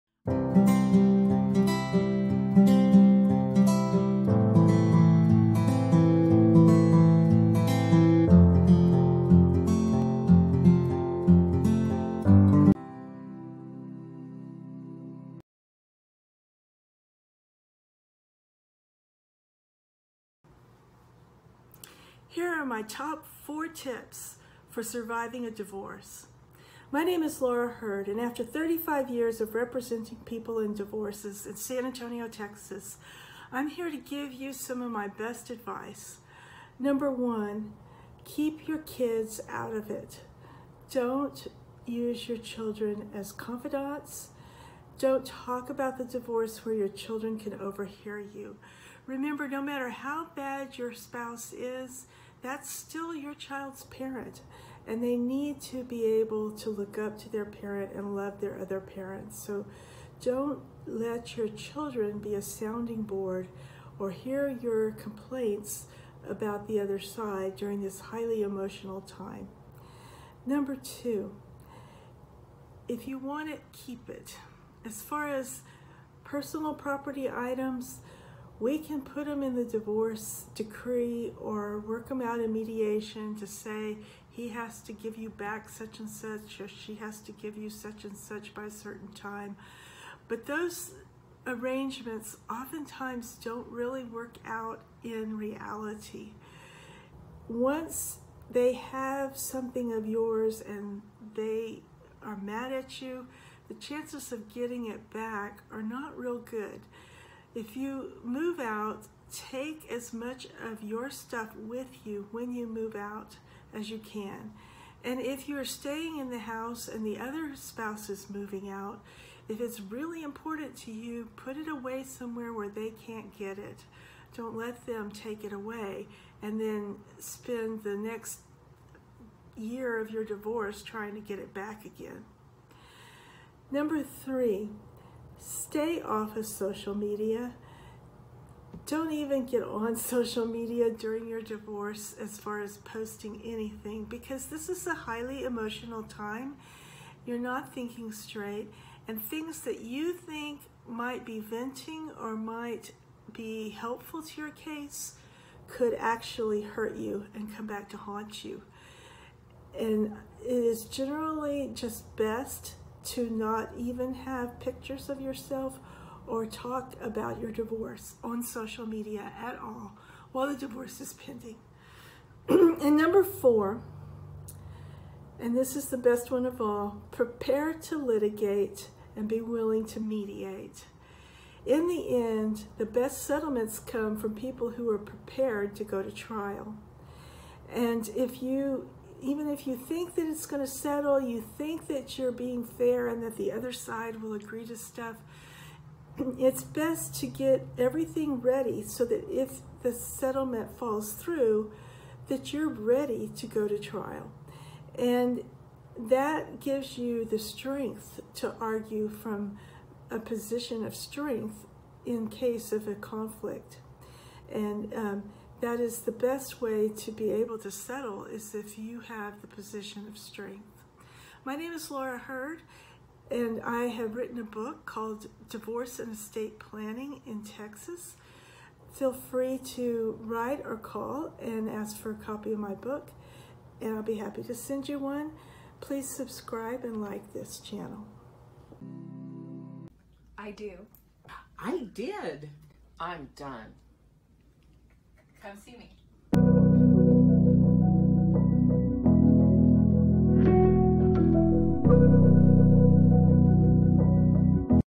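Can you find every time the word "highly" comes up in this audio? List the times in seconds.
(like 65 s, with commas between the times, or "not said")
67 s, 144 s.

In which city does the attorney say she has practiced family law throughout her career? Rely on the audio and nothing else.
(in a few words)
San Antonio.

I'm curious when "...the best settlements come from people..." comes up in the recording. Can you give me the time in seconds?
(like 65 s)
182 s.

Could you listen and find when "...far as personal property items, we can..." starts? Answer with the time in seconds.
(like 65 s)
75 s.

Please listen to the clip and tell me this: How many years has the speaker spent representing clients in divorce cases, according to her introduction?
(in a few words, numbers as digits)
35.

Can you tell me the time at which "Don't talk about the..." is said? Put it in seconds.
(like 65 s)
44 s.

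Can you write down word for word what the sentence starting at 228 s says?
Feel free to write or call and ask for a copy of my book, and I'll be happy to send you one.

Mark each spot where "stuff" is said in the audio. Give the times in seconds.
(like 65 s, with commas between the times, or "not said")
111 s, 194 s.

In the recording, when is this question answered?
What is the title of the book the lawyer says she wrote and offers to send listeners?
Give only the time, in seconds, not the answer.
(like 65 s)
225 s.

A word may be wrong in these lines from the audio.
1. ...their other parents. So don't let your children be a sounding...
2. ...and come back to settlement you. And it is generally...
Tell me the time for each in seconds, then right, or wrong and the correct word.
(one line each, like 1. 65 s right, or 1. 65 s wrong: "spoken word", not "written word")
1. 58 s right
2. 157 s wrong: "haunt", not "settlement".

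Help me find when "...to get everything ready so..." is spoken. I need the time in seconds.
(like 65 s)
197 s.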